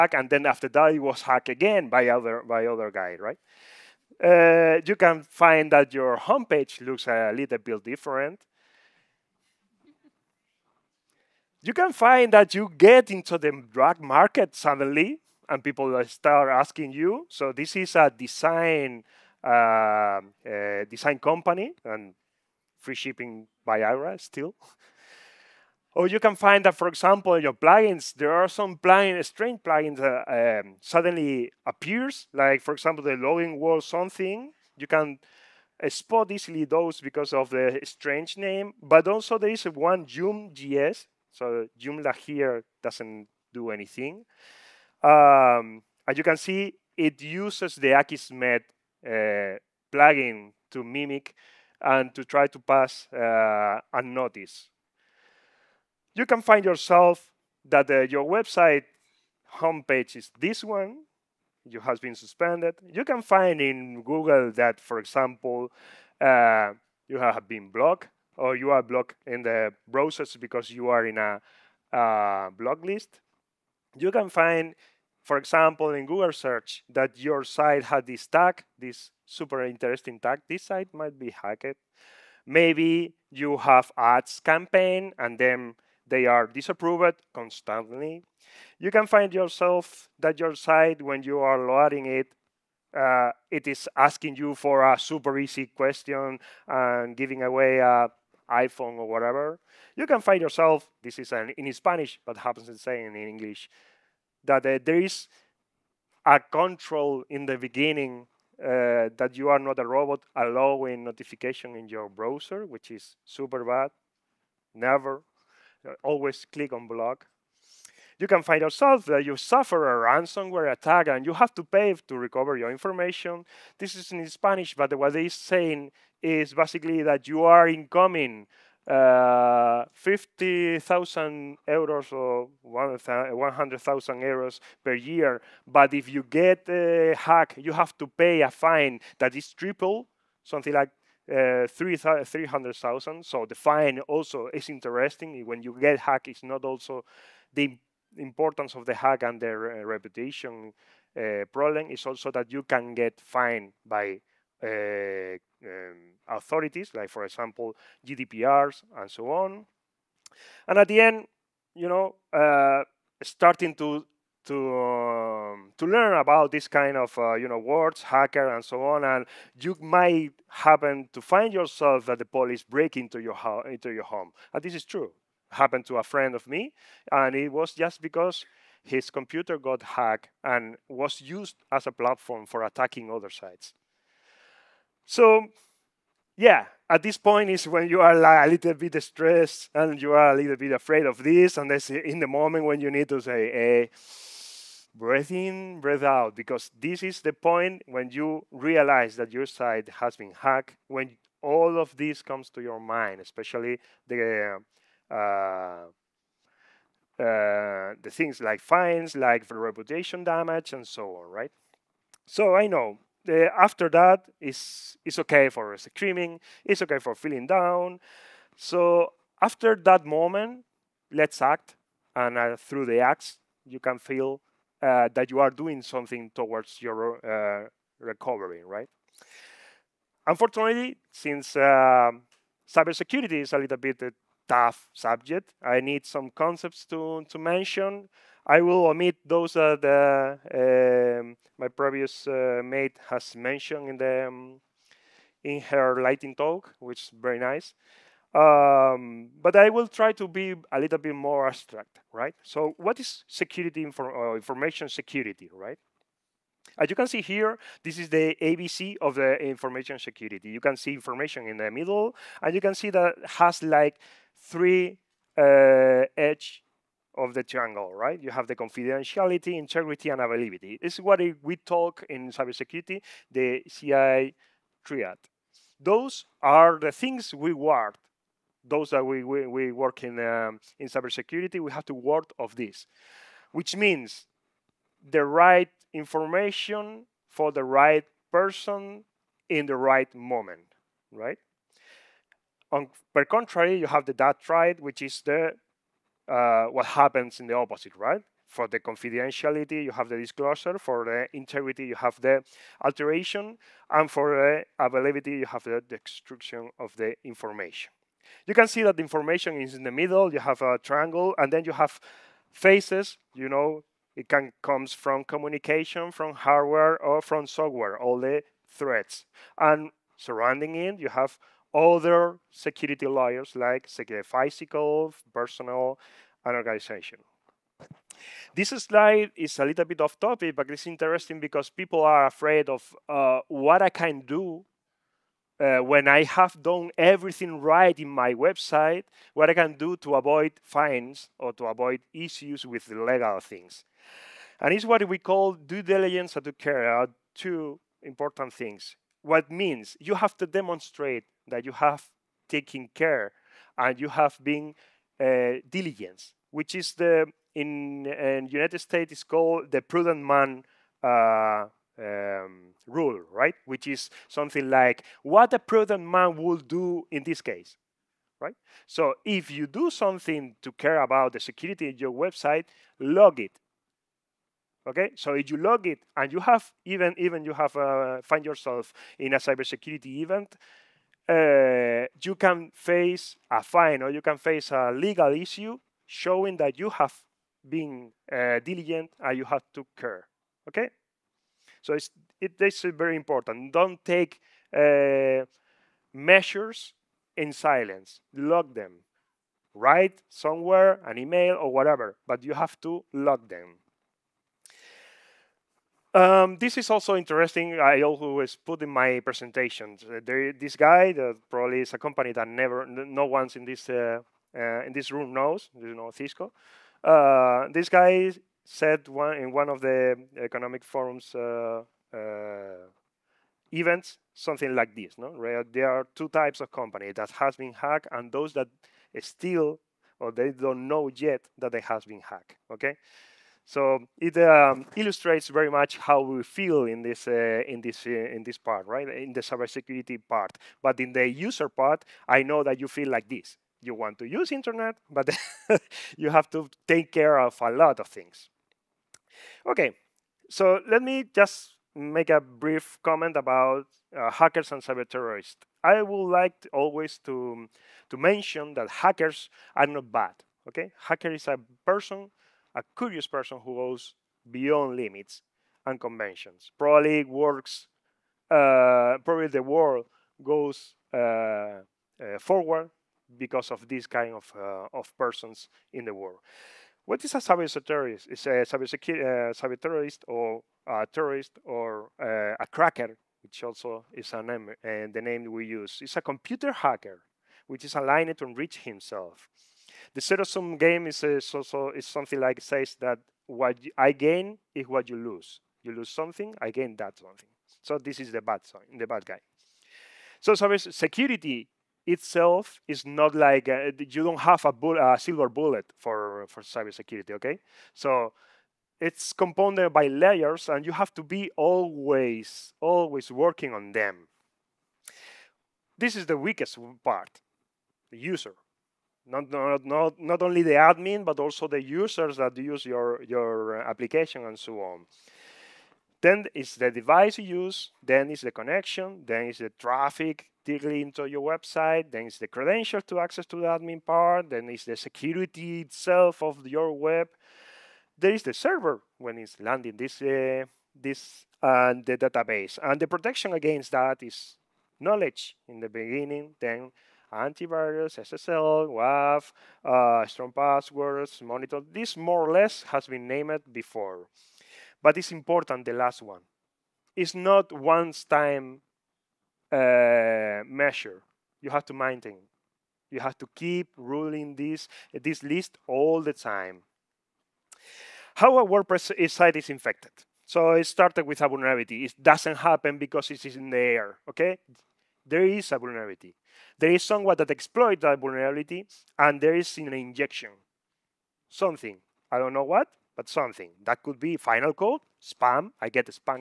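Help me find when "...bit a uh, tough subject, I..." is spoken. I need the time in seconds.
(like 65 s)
233 s.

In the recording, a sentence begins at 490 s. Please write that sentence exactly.
The zero sum game is, also is something like says that what I gain is what you lose.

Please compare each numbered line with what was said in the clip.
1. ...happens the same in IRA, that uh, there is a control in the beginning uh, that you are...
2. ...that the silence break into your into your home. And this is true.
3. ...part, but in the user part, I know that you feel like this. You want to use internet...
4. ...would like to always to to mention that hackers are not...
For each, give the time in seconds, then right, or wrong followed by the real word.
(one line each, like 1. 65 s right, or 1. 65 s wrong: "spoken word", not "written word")
1. 102 s wrong: "English", not "IRA"
2. 172 s wrong: "police", not "silence"
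3. 440 s right
4. 456 s right.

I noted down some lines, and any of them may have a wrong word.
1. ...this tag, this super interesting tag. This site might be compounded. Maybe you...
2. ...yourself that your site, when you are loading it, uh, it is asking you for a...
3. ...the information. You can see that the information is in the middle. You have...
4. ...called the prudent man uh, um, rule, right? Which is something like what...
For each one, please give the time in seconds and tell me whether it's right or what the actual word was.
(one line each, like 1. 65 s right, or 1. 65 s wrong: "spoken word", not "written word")
1. 78 s wrong: "hacked", not "compounded"
2. 89 s right
3. 306 s right
4. 359 s right.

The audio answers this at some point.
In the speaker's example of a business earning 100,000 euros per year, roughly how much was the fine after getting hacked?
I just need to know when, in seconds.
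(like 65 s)
141 s.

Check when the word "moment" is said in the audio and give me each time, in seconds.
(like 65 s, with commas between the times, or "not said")
192 s, 220 s, 290 s.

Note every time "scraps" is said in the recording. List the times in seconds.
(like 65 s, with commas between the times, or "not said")
not said.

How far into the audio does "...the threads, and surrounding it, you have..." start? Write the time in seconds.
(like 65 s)
318 s.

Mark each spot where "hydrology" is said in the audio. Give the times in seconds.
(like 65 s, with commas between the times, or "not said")
not said.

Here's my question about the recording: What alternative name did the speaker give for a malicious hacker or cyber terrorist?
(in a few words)
cracker.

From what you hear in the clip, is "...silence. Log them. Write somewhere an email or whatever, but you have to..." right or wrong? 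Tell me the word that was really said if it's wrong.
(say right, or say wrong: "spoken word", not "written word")
right.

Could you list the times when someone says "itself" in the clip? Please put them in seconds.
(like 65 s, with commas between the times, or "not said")
502 s, 535 s.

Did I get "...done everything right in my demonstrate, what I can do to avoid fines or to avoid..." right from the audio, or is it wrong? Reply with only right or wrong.
wrong.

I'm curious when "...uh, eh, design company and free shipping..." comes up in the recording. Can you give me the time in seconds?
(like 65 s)
19 s.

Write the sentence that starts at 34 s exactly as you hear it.
You can uh, spot easily those because of the strange name.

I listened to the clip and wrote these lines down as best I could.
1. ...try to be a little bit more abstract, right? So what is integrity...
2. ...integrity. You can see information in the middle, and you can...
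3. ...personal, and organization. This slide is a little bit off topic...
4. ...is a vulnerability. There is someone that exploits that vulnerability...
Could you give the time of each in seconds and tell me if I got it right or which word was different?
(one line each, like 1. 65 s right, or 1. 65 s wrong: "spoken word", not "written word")
1. 249 s wrong: "security", not "integrity"
2. 259 s wrong: "security", not "integrity"
3. 325 s right
4. 575 s right.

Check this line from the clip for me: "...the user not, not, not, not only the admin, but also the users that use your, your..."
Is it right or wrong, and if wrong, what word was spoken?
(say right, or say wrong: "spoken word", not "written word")
right.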